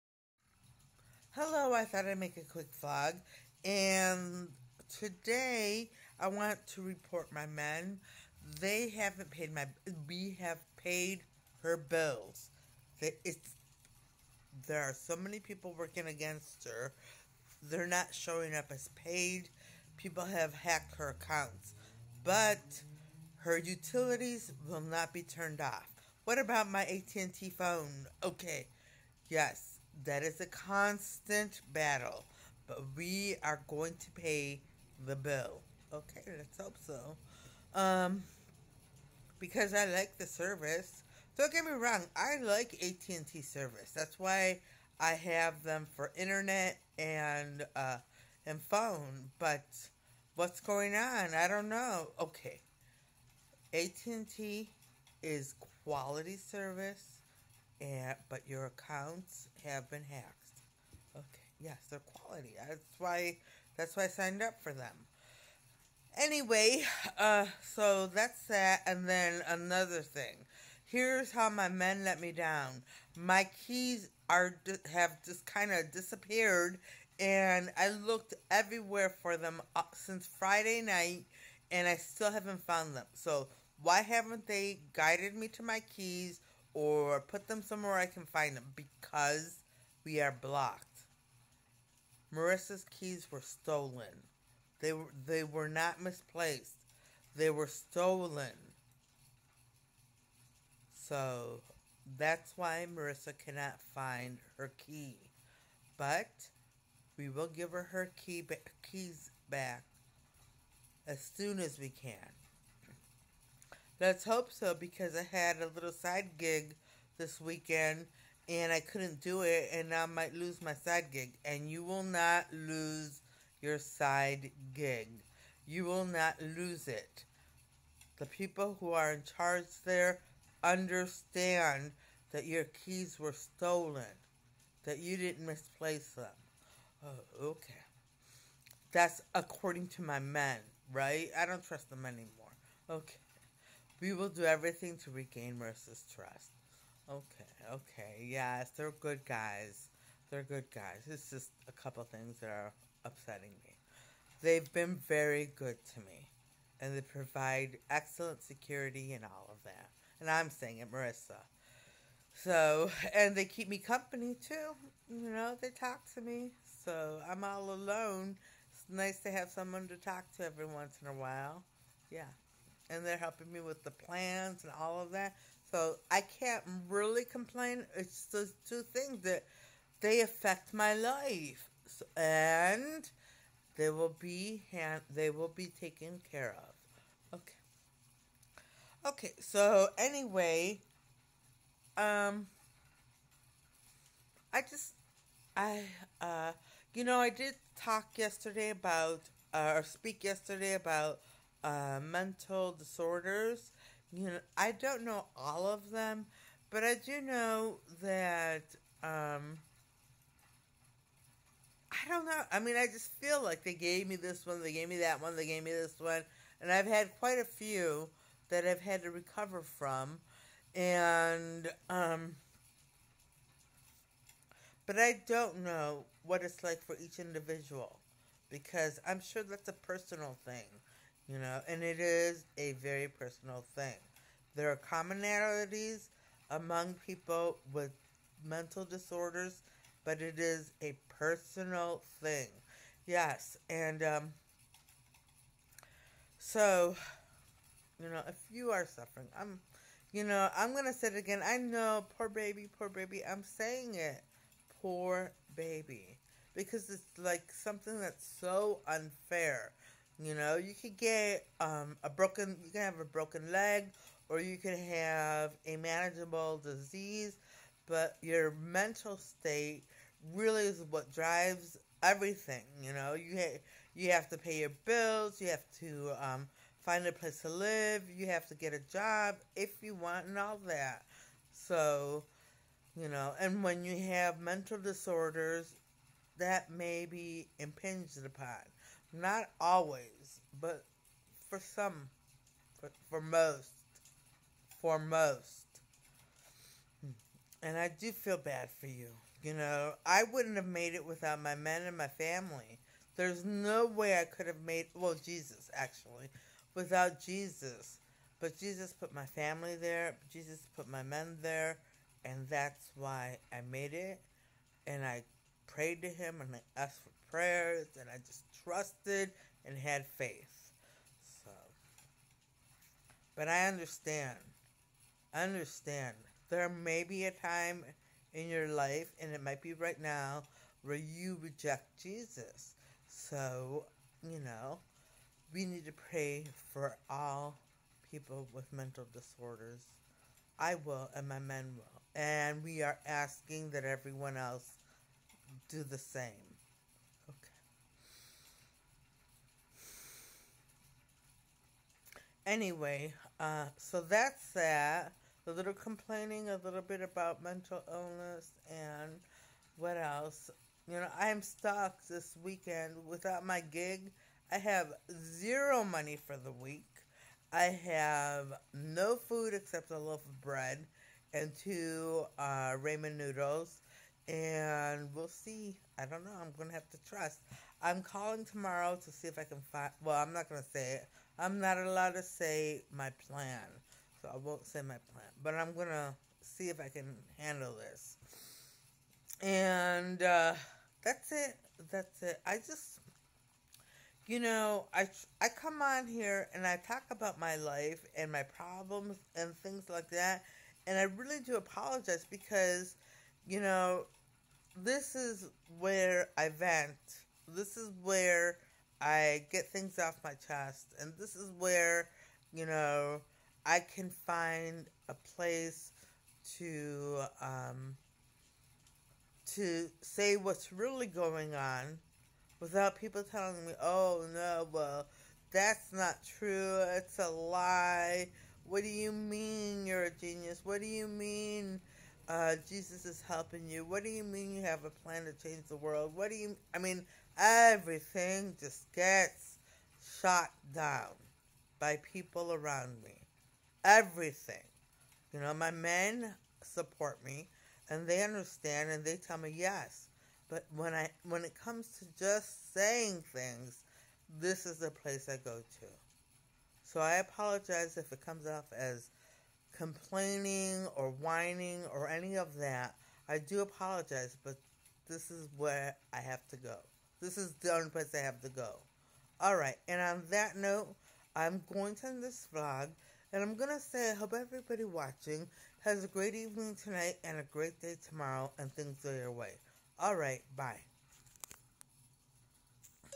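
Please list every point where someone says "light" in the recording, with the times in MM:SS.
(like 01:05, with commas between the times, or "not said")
not said.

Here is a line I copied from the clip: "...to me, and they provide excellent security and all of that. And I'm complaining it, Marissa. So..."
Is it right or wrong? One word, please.
wrong.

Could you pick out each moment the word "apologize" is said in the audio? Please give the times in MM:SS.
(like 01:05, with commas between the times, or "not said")
06:41, 07:37, 07:43.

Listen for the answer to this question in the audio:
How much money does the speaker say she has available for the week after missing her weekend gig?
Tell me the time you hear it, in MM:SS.
06:05.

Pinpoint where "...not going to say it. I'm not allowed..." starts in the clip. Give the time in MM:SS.
06:20.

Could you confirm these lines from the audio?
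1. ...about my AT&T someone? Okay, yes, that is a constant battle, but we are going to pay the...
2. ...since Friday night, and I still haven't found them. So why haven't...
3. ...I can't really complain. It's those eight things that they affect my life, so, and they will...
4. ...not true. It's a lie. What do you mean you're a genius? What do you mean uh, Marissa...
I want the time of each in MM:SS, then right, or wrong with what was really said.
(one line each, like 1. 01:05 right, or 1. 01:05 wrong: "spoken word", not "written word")
1. 00:26 wrong: "phone", not "someone"
2. 01:19 right
3. 02:56 wrong: "two", not "eight"
4. 07:05 wrong: "Jesus", not "Marissa".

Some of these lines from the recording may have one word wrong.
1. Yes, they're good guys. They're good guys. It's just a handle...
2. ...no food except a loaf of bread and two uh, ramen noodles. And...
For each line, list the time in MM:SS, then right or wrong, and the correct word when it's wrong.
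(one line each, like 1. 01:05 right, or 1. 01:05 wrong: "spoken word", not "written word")
1. 02:28 wrong: "couple", not "handle"
2. 06:08 right.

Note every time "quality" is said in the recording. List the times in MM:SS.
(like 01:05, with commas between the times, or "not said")
00:55, 01:01.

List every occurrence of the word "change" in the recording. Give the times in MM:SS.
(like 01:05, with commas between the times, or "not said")
07:15.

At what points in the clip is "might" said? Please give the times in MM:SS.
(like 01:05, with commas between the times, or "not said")
02:00, 05:29.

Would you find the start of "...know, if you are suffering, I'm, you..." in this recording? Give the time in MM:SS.
04:08.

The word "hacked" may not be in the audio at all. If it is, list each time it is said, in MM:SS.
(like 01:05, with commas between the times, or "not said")
00:20, 01:00.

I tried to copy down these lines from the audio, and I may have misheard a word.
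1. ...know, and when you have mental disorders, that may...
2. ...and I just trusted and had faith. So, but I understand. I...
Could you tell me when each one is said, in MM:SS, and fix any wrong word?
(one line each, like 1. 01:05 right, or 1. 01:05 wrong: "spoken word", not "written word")
1. 04:43 right
2. 05:17 right.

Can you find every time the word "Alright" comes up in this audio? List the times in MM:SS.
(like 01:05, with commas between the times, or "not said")
07:49, 08:00.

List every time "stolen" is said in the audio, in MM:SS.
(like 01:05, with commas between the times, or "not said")
01:33, 01:37, 02:13.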